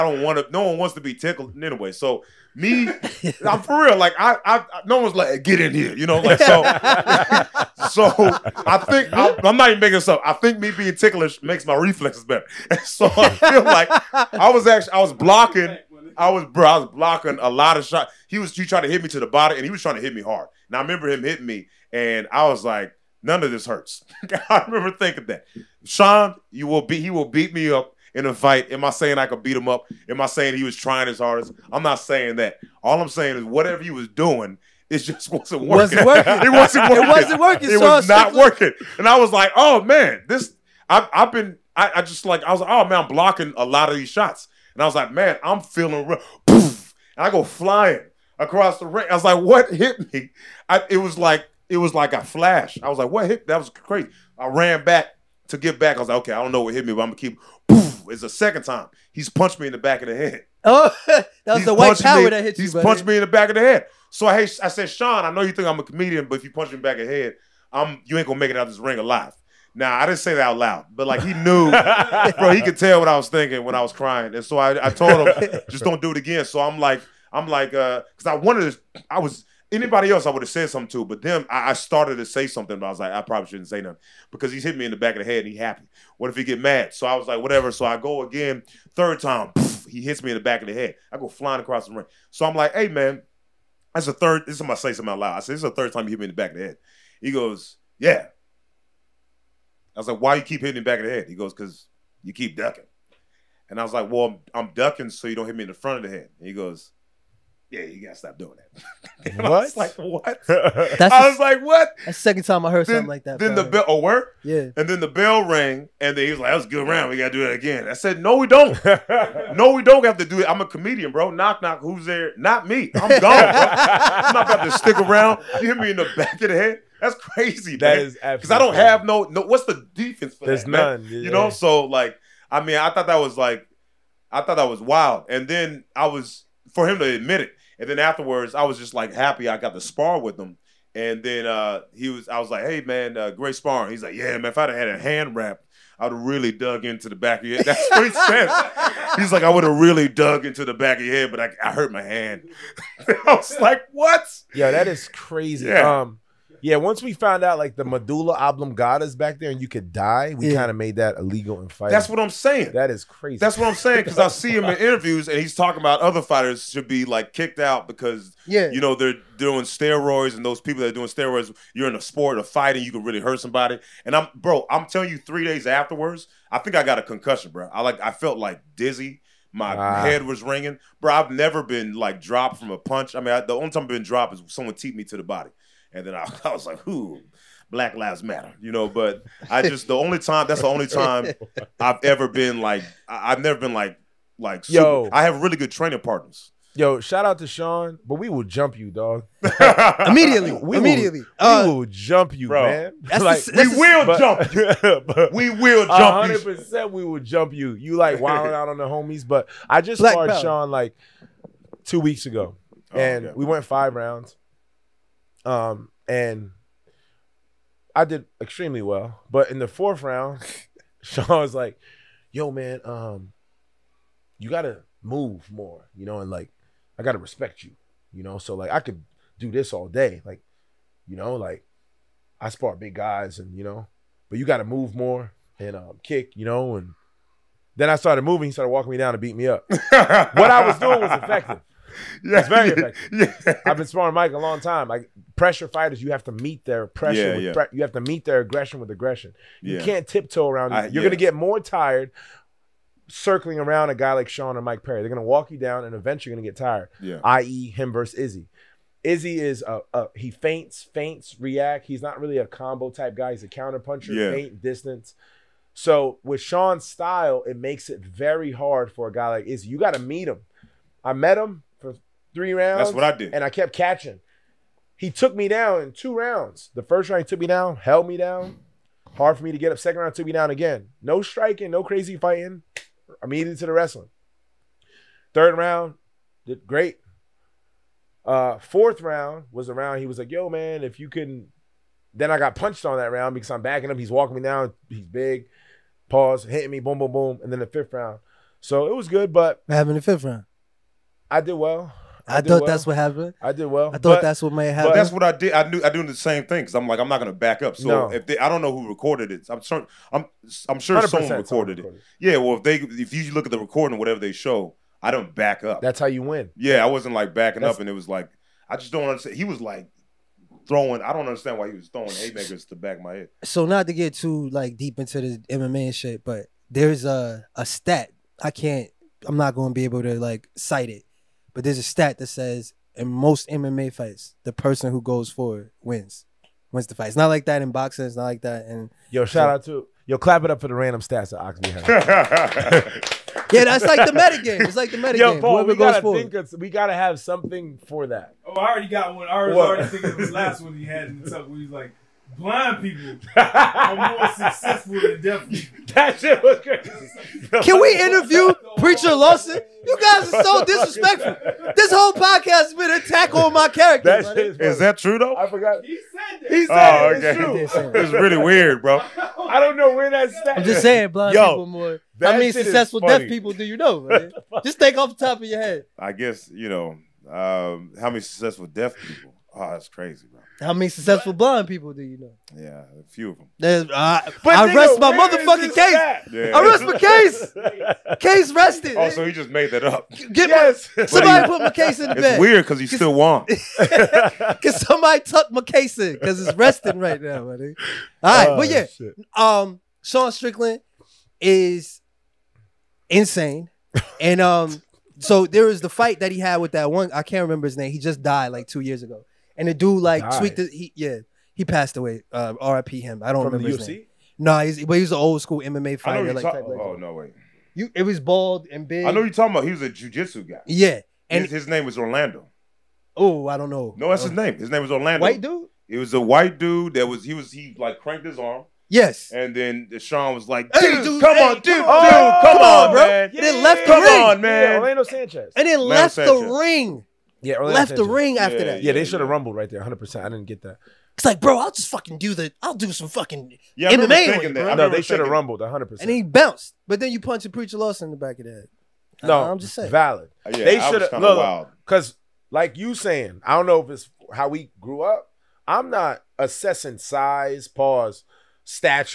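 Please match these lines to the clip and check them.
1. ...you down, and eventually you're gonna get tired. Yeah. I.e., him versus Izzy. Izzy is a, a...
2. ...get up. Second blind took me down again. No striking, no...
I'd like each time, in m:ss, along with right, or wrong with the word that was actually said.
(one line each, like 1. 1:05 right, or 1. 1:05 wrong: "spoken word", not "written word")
1. 4:15 right
2. 4:39 wrong: "round", not "blind".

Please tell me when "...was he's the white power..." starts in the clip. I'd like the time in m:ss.
1:01.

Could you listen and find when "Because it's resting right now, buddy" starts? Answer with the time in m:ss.
6:36.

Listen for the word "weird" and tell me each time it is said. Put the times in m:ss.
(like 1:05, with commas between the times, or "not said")
6:08, 6:32.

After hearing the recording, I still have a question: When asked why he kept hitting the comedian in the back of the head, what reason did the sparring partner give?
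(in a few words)
Because you keep ducking.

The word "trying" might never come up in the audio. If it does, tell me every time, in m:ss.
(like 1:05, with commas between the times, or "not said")
0:19, 0:30.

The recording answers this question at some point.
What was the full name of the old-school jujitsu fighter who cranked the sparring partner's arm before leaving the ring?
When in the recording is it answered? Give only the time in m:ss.
7:14.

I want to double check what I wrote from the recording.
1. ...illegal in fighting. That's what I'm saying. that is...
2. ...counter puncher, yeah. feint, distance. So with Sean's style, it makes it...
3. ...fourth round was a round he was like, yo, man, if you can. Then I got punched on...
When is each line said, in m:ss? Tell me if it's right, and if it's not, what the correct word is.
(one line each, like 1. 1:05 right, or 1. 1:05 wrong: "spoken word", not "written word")
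1. 2:41 right
2. 4:23 right
3. 4:48 right.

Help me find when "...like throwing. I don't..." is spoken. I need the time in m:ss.
5:19.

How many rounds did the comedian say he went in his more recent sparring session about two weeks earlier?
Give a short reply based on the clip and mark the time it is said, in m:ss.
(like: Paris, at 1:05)
5, at 3:33.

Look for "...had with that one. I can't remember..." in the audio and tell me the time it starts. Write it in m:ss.
6:46.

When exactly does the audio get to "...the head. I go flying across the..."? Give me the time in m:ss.
1:30.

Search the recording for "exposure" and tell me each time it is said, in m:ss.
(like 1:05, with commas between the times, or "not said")
not said.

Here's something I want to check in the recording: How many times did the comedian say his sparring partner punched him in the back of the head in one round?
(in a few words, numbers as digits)
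3.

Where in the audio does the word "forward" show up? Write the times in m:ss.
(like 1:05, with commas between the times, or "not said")
5:35, 5:45.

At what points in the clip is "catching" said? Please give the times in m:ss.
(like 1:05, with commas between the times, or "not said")
4:33.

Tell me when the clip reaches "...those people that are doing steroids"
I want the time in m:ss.
2:50.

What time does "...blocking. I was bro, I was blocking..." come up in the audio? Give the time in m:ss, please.
0:15.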